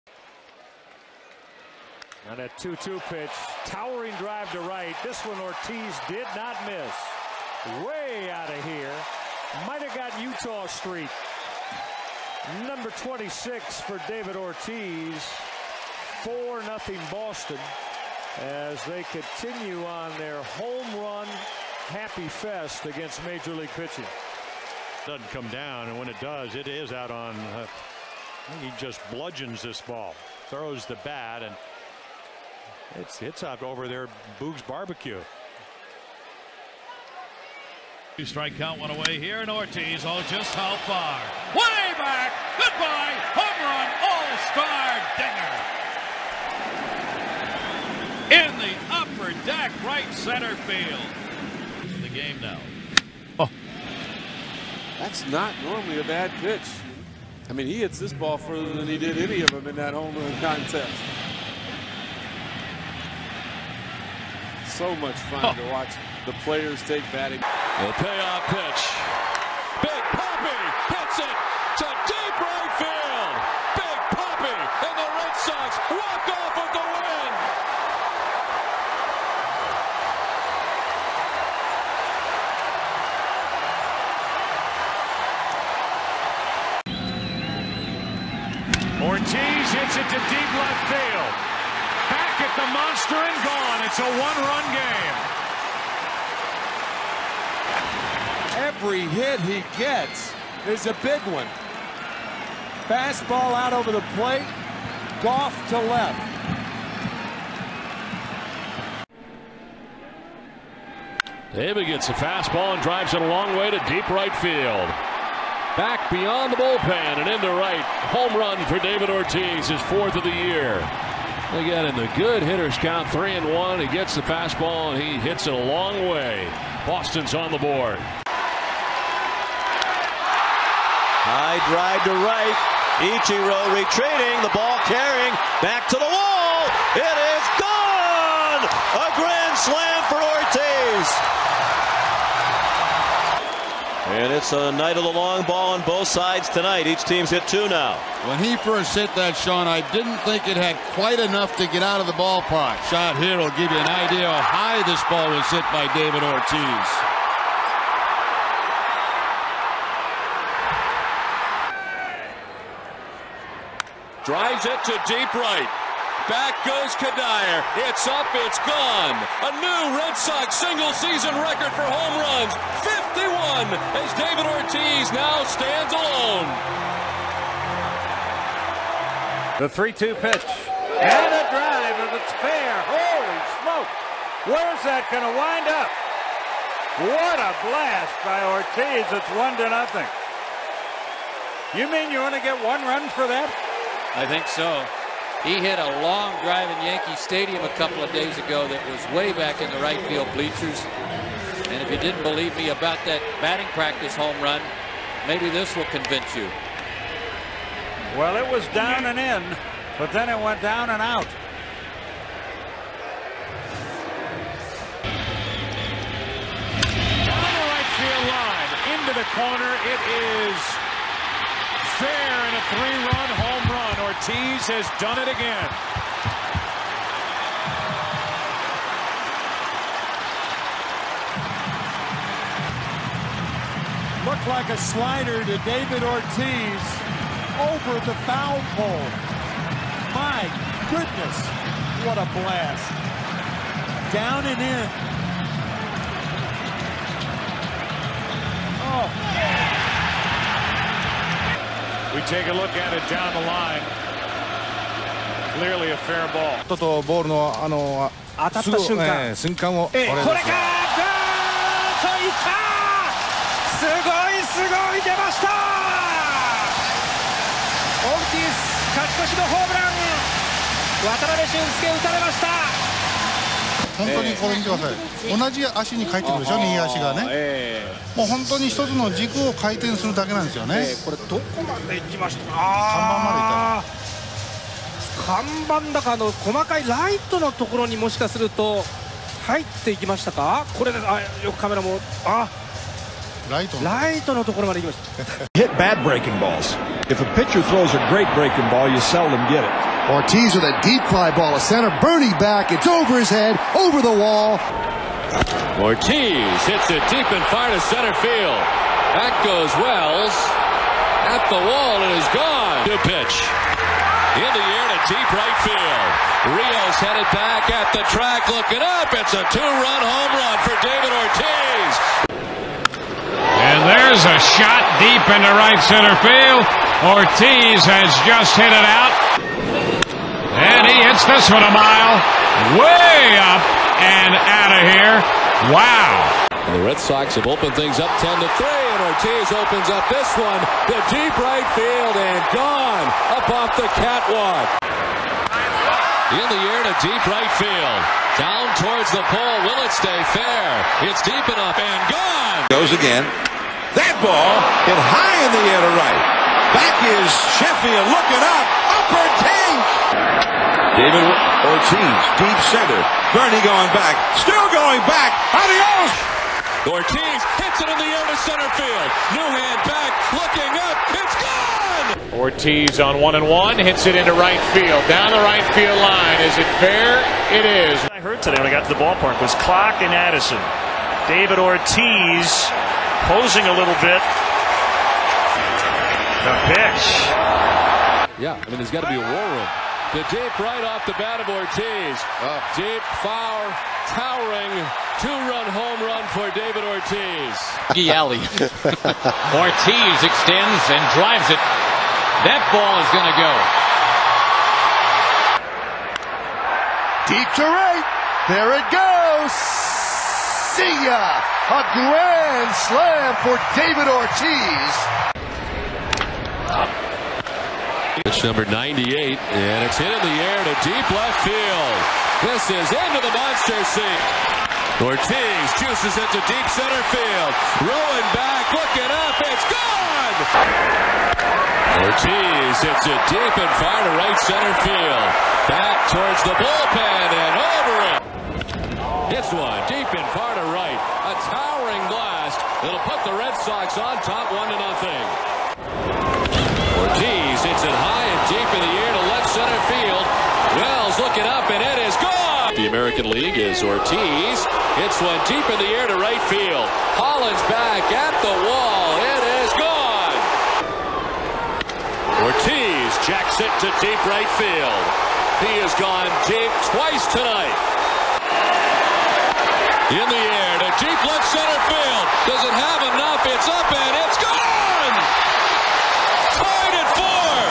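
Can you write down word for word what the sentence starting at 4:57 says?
If a pitcher throws a great breaking ball, you seldom get it.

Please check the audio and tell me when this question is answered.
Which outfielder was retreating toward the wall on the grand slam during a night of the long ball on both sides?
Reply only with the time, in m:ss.
2:13.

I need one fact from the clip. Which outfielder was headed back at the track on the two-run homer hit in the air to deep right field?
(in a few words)
Rios.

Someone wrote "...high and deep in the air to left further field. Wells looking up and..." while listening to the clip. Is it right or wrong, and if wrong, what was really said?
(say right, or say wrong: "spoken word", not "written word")
wrong: "center", not "further".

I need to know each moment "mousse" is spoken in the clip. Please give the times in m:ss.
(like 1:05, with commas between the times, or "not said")
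not said.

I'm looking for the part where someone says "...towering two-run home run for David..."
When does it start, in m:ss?
6:34.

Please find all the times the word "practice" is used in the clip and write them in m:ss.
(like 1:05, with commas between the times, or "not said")
3:23.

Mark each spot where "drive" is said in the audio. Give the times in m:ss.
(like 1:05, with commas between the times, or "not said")
0:04, 1:52, 2:11, 2:44, 3:01, 3:16, 6:41.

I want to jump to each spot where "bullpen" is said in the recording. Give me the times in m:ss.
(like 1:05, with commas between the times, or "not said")
1:56, 7:16.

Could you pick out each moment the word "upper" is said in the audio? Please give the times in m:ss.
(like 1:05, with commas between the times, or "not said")
0:48, 5:58.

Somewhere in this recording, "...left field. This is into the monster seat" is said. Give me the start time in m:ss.
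7:01.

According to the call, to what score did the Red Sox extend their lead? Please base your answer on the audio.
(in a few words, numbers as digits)
10 to 3.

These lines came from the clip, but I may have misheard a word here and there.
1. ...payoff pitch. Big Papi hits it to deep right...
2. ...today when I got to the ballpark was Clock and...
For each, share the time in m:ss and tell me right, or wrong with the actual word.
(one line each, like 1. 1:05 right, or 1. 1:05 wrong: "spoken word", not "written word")
1. 1:08 right
2. 6:18 right.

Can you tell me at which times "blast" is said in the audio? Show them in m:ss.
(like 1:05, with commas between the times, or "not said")
3:07, 4:02.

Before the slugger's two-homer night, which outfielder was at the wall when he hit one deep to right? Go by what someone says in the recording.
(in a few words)
Holland.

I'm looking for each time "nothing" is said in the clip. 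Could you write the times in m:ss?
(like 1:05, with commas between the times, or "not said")
0:16, 3:09, 7:24.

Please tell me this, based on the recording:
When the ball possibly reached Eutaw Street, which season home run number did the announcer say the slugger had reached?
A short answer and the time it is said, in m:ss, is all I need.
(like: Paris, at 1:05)
26, at 0:12.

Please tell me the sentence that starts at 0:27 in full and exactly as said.
Uh, he just bludgeons this ball, throws the bat, and it's up over there, Boog's barbecue.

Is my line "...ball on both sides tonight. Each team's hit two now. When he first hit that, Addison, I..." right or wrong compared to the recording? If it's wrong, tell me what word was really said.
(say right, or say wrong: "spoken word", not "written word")
wrong: "Sean", not "Addison".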